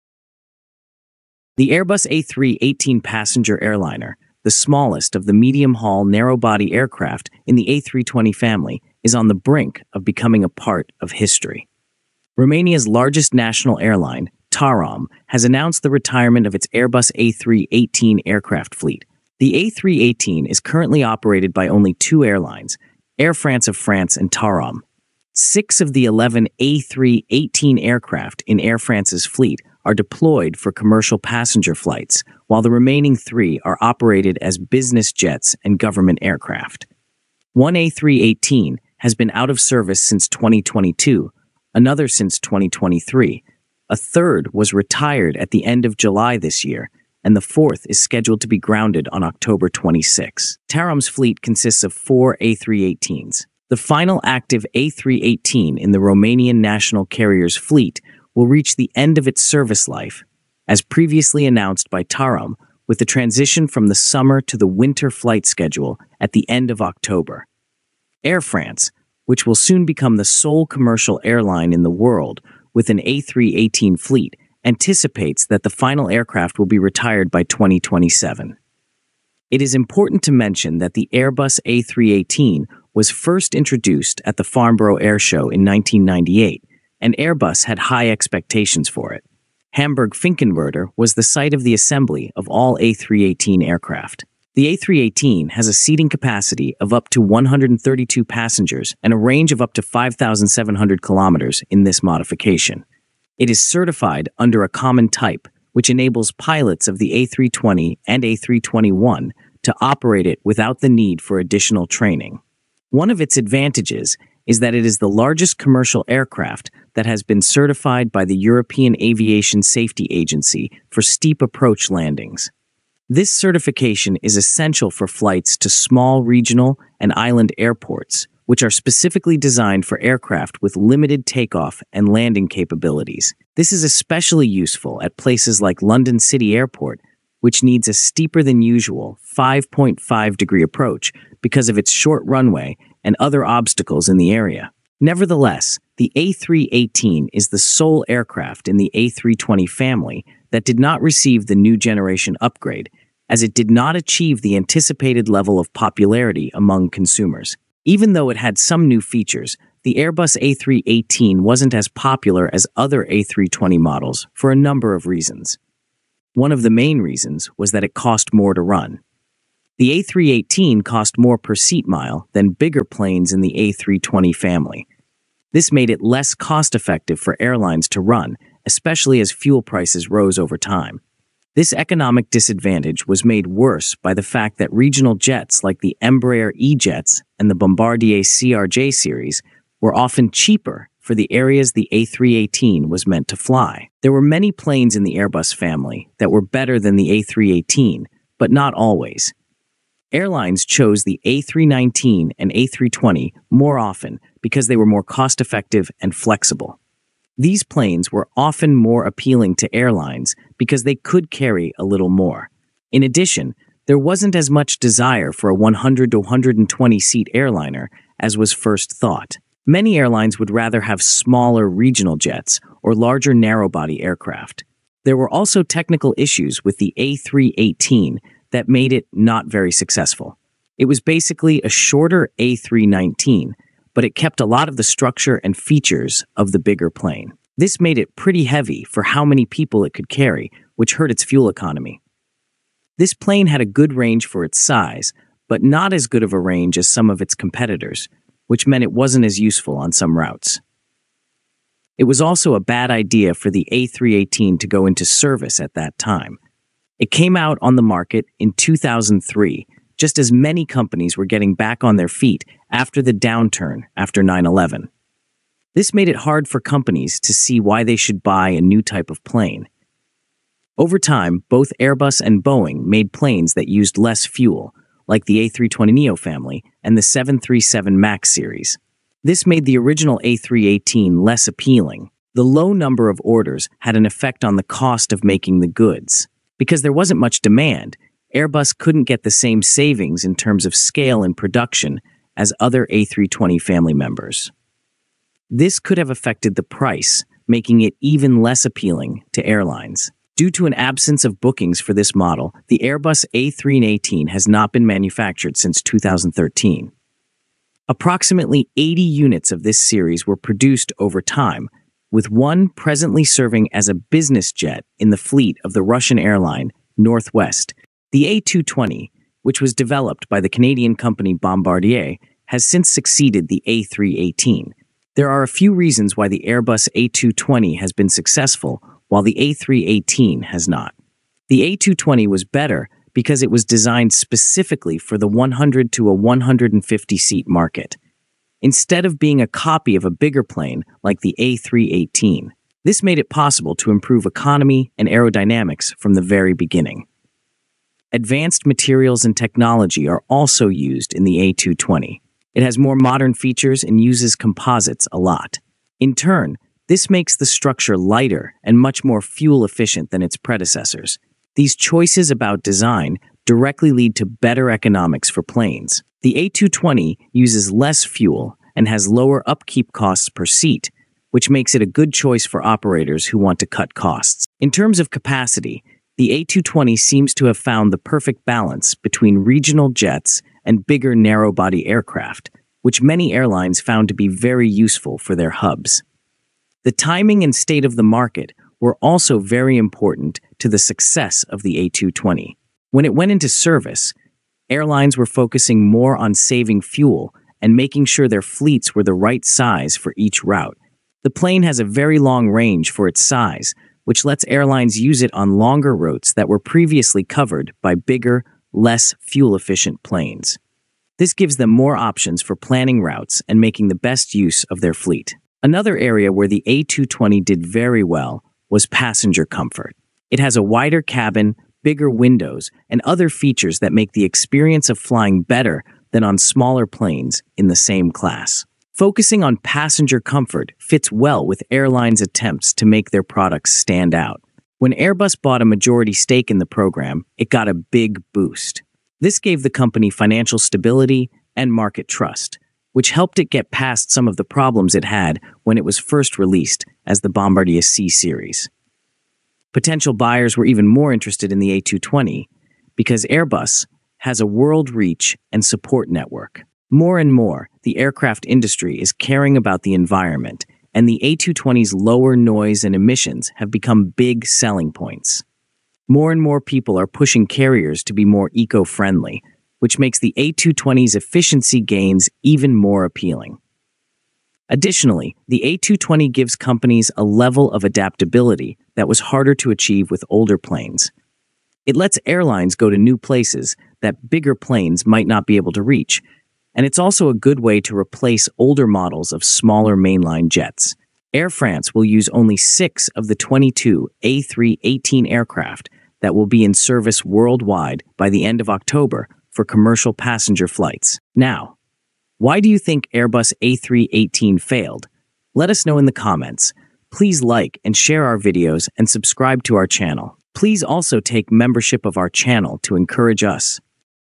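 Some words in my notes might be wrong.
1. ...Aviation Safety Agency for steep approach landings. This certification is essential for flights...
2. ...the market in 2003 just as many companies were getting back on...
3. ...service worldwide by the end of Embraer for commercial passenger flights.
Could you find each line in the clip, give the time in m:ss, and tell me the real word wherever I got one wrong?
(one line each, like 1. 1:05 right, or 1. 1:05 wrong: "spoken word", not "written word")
1. 1:59 right
2. 4:17 right
3. 8:16 wrong: "October", not "Embraer".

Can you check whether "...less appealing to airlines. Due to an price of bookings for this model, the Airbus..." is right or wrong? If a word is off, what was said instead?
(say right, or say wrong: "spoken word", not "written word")
wrong: "absence", not "price".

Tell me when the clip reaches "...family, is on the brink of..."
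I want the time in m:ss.
0:08.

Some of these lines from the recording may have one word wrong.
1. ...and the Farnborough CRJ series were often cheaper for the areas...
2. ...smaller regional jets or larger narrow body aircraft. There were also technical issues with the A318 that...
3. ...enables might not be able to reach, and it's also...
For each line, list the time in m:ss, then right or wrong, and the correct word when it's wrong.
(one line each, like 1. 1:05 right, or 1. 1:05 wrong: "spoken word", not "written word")
1. 3:07 wrong: "Bombardier", not "Farnborough"
2. 3:41 right
3. 8:04 wrong: "planes", not "enables".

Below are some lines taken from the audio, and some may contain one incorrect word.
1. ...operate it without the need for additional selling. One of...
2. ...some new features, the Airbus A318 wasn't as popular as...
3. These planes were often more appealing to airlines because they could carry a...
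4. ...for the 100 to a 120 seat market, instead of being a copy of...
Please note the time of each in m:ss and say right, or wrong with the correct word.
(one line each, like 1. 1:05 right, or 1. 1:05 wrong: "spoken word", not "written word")
1. 1:49 wrong: "training", not "selling"
2. 2:38 right
3. 3:27 right
4. 5:34 wrong: "150", not "120".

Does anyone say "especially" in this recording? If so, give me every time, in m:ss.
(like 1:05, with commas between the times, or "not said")
2:13, 2:58.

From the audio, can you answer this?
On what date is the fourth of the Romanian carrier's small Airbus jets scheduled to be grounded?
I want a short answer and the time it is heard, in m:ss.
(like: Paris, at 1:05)
October 26, at 0:49.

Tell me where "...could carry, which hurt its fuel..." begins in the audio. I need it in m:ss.
3:59.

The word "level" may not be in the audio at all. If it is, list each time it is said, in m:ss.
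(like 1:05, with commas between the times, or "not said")
2:35, 7:57.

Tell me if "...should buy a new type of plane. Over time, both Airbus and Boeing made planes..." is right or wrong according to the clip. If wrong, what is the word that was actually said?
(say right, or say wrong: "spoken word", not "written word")
right.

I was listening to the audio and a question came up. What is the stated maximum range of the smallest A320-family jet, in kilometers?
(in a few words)
5,700 kilometers.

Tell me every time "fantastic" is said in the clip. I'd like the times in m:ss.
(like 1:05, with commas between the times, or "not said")
not said.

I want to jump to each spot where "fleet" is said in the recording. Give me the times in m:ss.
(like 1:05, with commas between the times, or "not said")
0:18, 0:29, 0:51, 0:57, 1:13, 5:15, 6:38, 6:54.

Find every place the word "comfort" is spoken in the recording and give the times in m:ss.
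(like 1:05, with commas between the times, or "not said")
6:59, 7:10.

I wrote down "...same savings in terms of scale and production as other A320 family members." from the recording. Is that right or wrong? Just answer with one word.
right.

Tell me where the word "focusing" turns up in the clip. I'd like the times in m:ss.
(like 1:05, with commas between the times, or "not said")
6:35, 7:09.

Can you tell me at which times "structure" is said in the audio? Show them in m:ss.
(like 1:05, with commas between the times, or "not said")
3:54, 5:57.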